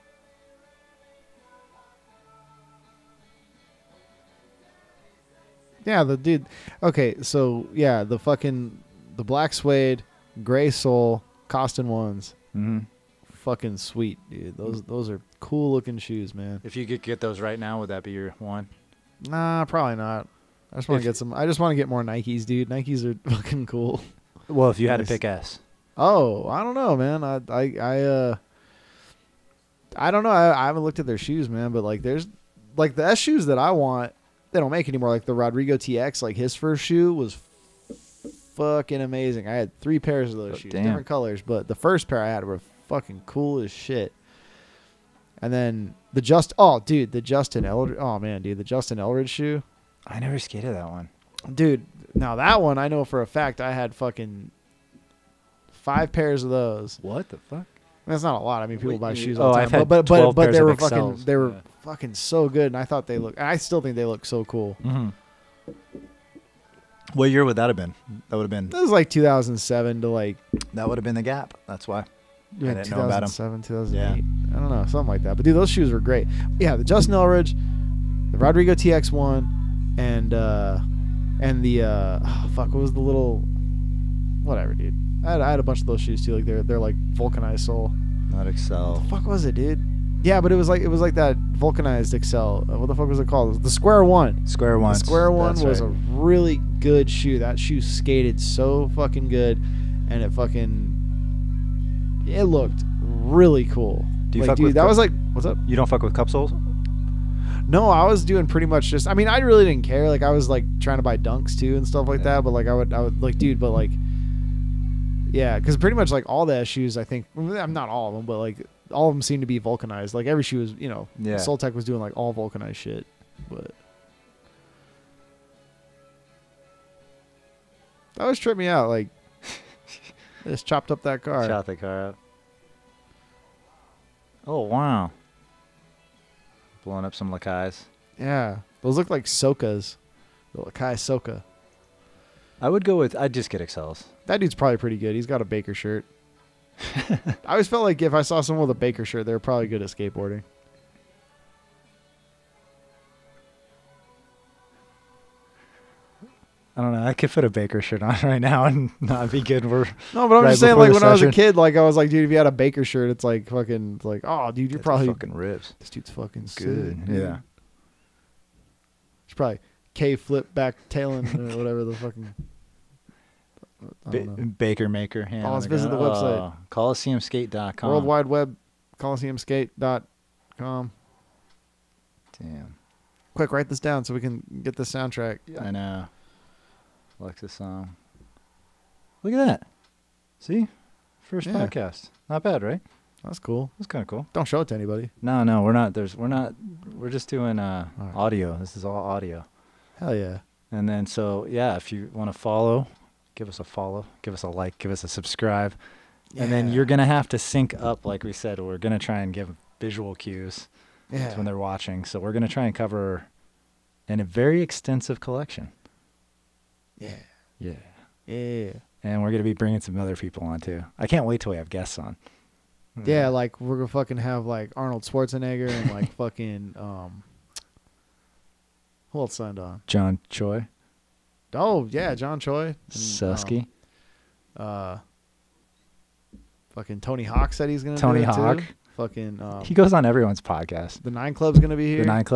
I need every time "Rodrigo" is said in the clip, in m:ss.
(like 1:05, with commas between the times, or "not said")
0:35, 1:18.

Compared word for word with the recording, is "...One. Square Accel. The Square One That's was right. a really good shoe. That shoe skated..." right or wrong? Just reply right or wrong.
wrong.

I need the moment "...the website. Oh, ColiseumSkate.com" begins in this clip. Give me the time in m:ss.
2:55.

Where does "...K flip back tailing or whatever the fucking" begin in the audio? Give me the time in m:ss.
2:49.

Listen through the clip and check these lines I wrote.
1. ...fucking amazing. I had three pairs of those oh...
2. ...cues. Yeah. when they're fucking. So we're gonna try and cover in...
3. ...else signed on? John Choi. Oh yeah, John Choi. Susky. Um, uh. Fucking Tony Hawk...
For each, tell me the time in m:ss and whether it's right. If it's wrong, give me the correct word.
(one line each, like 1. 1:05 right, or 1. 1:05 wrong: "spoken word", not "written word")
1. 0:38 right
2. 3:30 wrong: "watching", not "fucking"
3. 3:49 right.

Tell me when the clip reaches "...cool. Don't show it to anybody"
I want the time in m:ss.
3:14.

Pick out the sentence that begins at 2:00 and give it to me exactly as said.
Like every shoe was, you know, yeah.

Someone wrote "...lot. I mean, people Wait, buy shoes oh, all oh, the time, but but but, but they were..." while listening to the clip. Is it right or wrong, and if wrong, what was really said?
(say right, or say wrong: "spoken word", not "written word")
right.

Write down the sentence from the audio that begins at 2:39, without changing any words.
for no, but I'm right just saying, like when session.